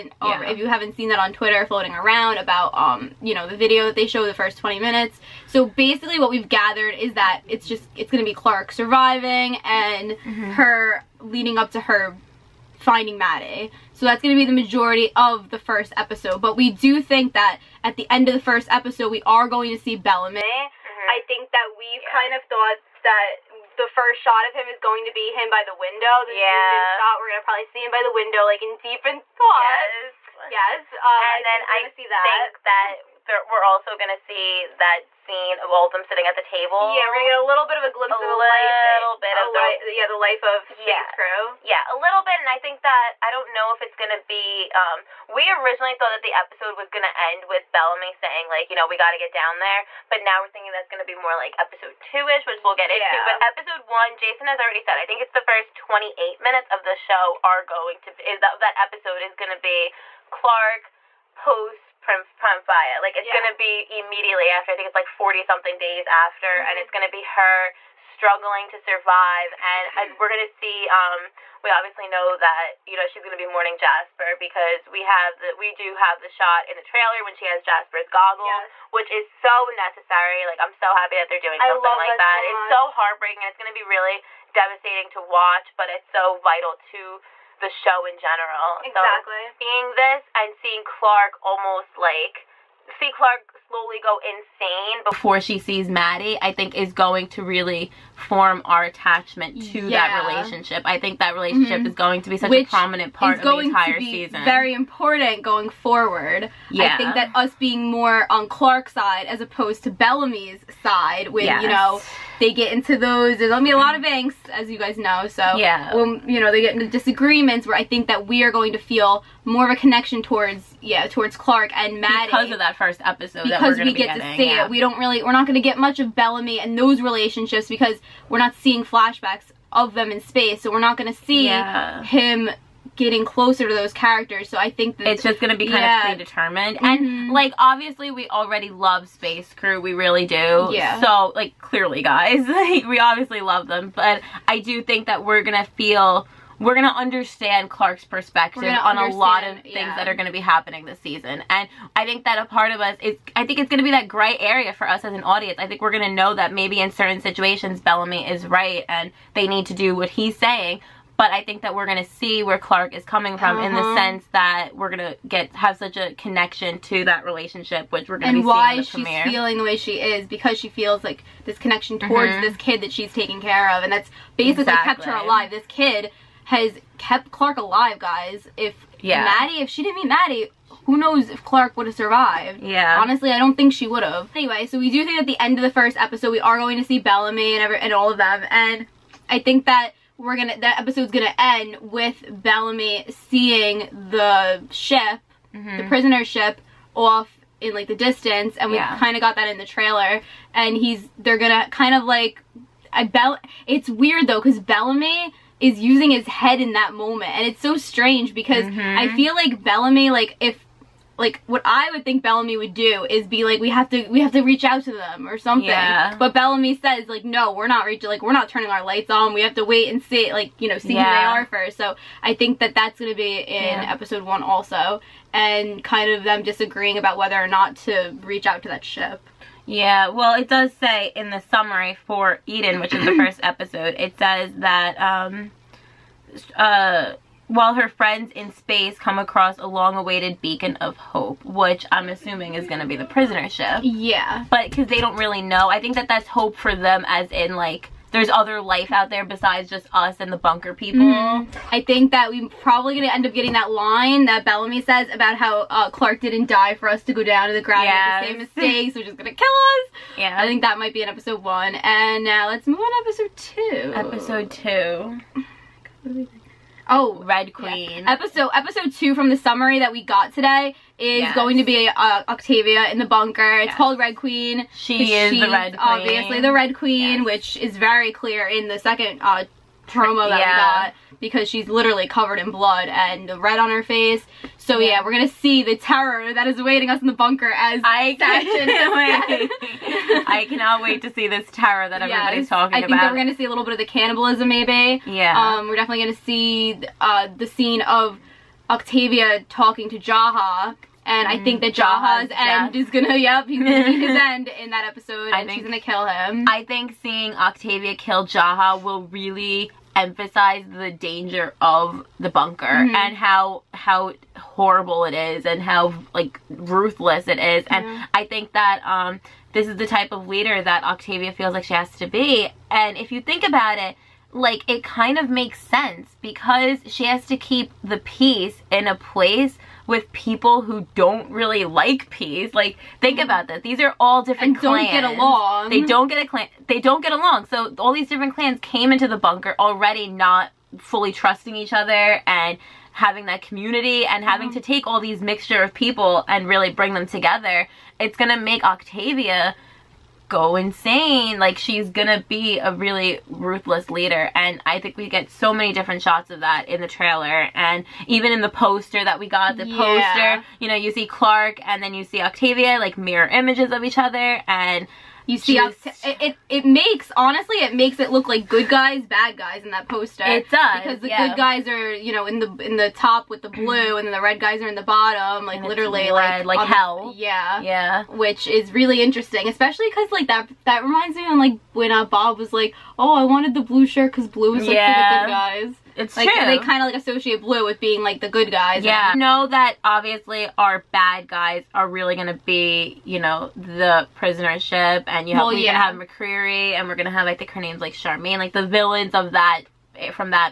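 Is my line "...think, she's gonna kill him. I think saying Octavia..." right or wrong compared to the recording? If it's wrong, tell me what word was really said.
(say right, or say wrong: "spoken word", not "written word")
wrong: "seeing", not "saying".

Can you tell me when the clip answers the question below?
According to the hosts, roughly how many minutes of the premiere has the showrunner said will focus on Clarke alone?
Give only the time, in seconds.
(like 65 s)
55 s.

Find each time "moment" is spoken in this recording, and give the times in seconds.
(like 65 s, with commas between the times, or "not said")
206 s.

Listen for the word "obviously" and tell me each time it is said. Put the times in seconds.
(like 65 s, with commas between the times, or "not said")
71 s, 137 s, 143 s, 275 s, 389 s.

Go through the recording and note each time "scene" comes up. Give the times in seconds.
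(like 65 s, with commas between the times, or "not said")
35 s, 297 s.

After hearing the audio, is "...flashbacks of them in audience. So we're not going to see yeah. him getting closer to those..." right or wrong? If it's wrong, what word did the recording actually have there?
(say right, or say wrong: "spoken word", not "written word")
wrong: "space", not "audience".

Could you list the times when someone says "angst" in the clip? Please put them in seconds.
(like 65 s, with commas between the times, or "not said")
114 s.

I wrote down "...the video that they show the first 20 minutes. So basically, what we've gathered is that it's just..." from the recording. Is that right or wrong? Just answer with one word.
right.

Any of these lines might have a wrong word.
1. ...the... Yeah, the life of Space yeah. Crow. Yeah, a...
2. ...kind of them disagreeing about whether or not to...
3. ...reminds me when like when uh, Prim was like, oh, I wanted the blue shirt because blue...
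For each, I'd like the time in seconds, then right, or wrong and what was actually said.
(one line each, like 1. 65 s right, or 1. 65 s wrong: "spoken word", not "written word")
1. 39 s right
2. 225 s right
3. 380 s wrong: "Bob", not "Prim".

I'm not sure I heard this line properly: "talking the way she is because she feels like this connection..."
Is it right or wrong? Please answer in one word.
wrong.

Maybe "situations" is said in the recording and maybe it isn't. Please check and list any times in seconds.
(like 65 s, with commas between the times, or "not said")
157 s.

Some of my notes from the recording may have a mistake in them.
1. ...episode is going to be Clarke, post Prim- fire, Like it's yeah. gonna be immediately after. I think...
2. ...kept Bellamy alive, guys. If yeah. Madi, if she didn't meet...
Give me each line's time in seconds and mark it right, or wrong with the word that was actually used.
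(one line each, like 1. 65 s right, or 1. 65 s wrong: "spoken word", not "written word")
1. 58 s right
2. 176 s wrong: "Clarke", not "Bellamy".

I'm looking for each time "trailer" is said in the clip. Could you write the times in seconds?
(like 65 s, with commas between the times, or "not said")
76 s, 199 s, 356 s.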